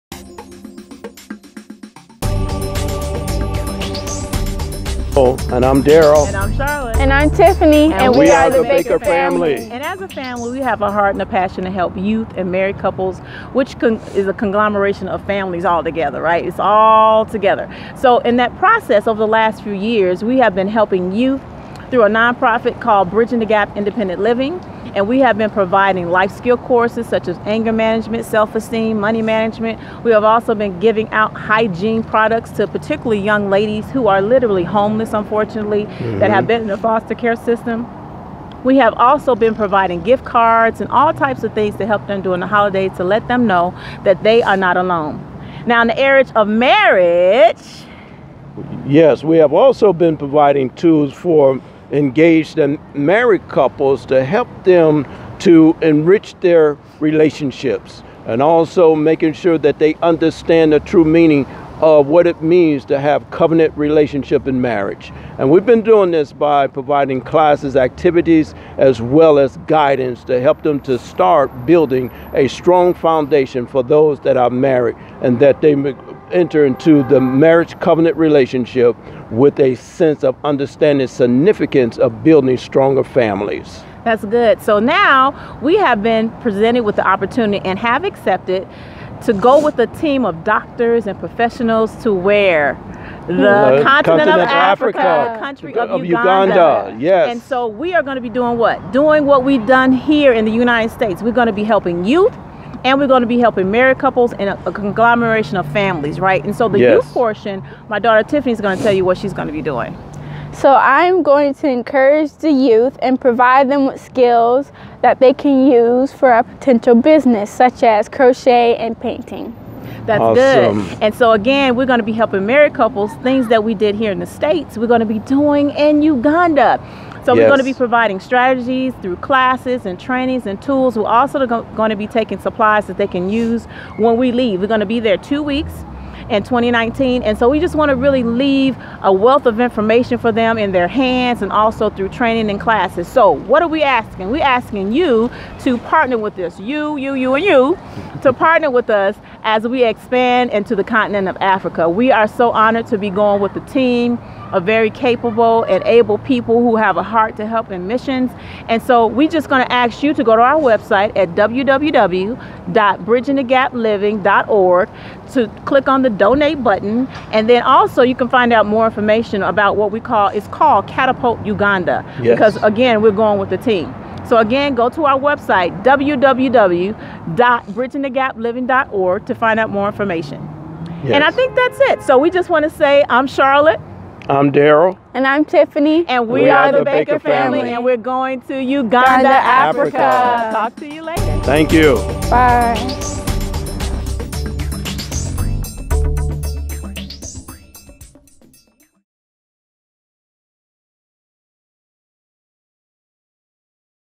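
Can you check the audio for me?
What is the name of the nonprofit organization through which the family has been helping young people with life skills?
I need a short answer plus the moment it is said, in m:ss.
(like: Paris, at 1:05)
Bridging the Gap Independent Living, at 0:23.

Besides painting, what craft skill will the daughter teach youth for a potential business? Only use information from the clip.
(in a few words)
Crochet.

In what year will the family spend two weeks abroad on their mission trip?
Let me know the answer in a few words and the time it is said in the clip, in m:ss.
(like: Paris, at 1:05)
2019, at 2:16.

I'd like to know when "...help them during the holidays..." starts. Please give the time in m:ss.
0:41.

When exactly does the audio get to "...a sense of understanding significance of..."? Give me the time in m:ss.
1:19.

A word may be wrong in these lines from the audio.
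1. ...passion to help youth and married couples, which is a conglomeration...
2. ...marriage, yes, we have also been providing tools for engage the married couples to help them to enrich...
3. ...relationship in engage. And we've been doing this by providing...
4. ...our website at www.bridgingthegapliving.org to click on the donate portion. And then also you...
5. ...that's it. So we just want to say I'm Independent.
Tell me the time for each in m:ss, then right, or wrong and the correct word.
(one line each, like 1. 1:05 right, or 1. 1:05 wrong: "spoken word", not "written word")
1. 0:11 right
2. 0:46 right
3. 1:03 wrong: "marriage", not "engage"
4. 2:40 wrong: "button", not "portion"
5. 3:01 wrong: "Charlotte", not "Independent".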